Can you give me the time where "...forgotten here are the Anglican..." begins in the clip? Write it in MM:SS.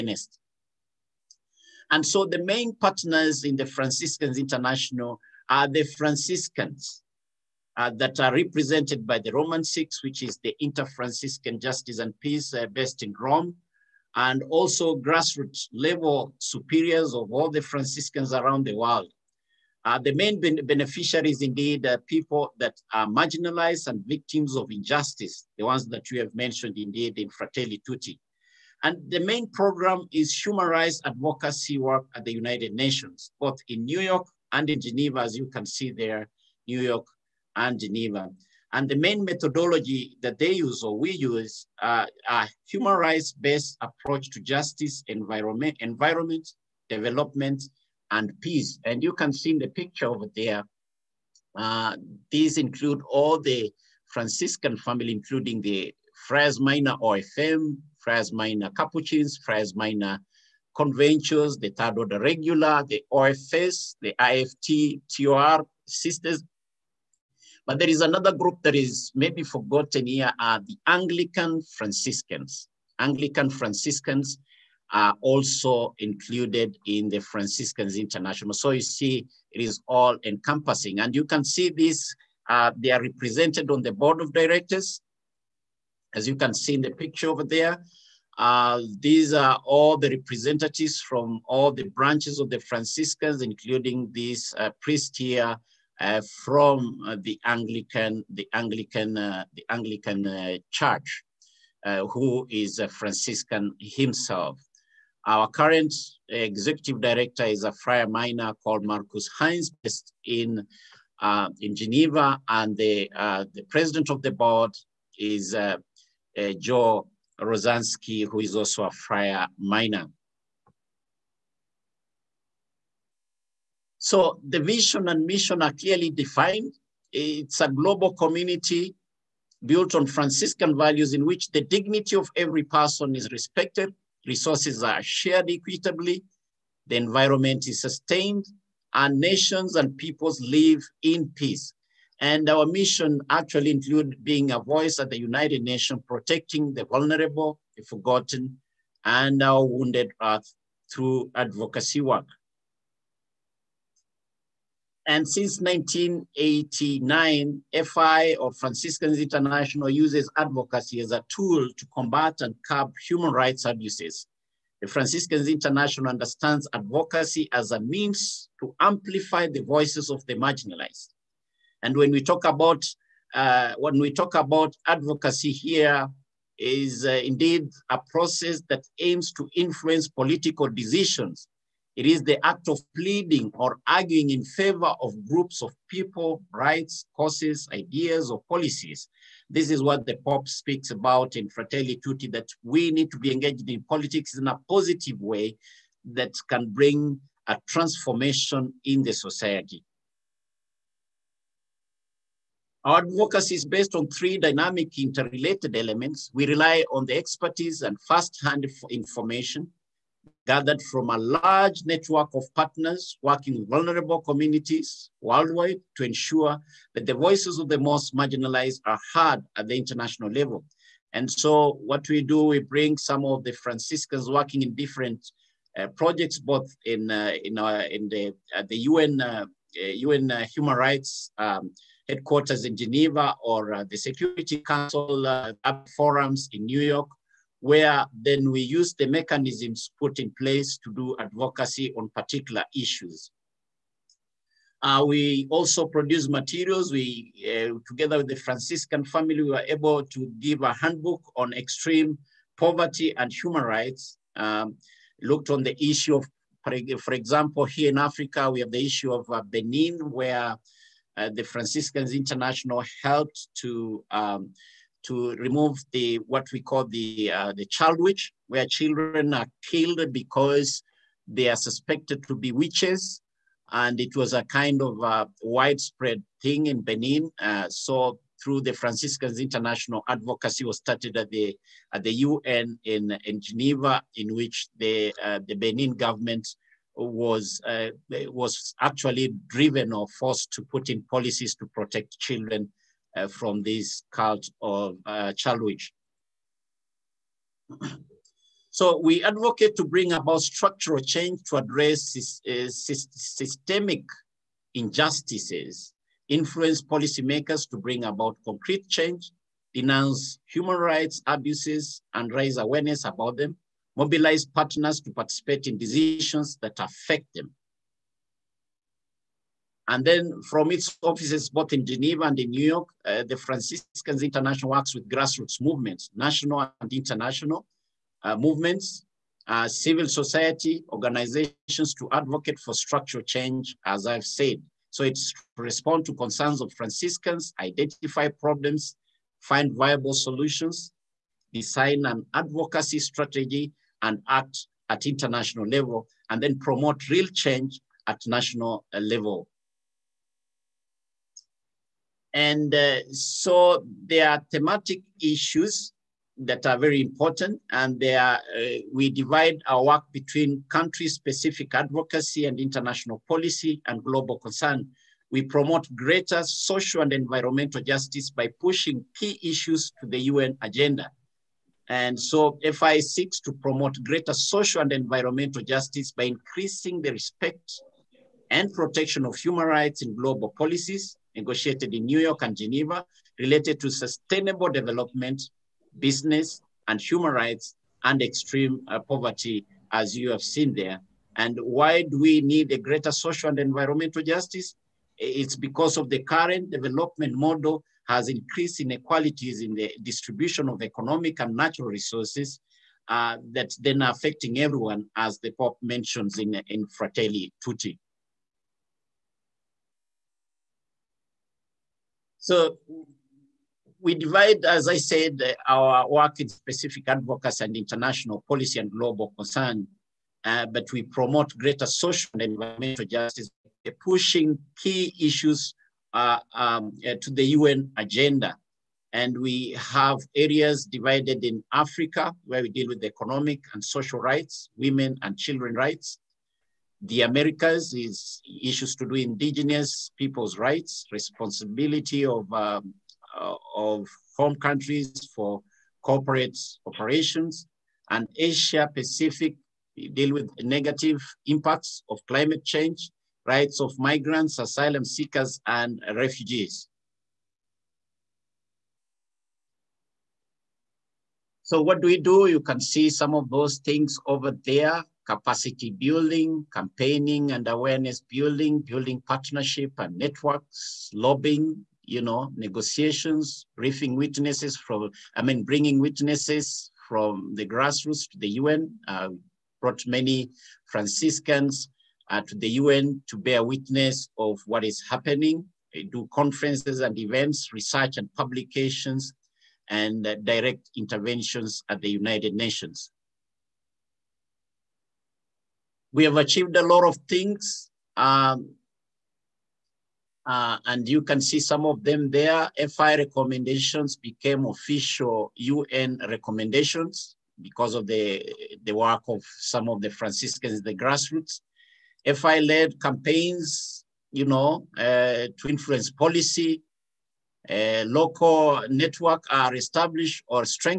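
01:09.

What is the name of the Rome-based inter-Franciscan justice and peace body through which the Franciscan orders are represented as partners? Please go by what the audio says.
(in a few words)
Romans Six.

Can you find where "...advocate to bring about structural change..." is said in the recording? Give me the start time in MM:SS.
04:59.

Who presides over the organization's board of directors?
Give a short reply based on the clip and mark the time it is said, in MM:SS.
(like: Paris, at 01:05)
Joe Rozansky, at 01:56.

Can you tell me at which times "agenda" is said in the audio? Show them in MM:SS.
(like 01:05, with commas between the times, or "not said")
06:10, 07:07.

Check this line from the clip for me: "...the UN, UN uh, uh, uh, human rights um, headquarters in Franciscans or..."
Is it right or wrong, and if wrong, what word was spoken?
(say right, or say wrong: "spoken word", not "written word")
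wrong: "Geneva", not "Franciscans".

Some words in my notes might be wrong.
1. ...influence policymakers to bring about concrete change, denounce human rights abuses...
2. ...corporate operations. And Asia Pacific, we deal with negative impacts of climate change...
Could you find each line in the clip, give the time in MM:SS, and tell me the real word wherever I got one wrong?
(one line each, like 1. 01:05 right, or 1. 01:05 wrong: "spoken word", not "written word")
1. 05:06 right
2. 07:26 right.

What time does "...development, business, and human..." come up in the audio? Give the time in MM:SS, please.
06:24.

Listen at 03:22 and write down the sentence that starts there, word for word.
Our advocacy is based on three dynamic interrelated elements.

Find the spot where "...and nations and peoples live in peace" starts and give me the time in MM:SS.
02:18.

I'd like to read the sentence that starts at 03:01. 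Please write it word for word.
It is the act of pleading or arguing in favor of groups of people, rights, causes, ideas, or policies.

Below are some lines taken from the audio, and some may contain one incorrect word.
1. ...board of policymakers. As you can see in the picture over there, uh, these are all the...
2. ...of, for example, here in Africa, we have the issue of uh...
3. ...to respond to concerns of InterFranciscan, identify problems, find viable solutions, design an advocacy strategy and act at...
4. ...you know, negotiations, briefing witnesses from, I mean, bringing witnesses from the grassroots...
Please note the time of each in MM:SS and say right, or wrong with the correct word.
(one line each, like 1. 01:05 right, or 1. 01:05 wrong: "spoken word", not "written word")
1. 01:23 wrong: "directors", not "policymakers"
2. 04:16 right
3. 05:35 wrong: "Franciscans", not "InterFranciscan"
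4. 07:52 right.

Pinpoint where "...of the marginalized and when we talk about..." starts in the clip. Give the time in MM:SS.
02:50.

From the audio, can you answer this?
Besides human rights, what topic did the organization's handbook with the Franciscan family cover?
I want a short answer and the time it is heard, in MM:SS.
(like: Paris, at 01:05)
extreme poverty, at 04:11.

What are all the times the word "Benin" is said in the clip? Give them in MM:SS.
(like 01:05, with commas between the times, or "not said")
04:19, 04:36, 04:45.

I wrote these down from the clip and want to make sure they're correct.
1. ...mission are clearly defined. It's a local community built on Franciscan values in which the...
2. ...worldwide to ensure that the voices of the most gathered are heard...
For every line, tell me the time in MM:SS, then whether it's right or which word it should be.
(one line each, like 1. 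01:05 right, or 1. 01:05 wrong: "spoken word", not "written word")
1. 02:05 wrong: "global", not "local"
2. 03:35 wrong: "marginalized", not "gathered".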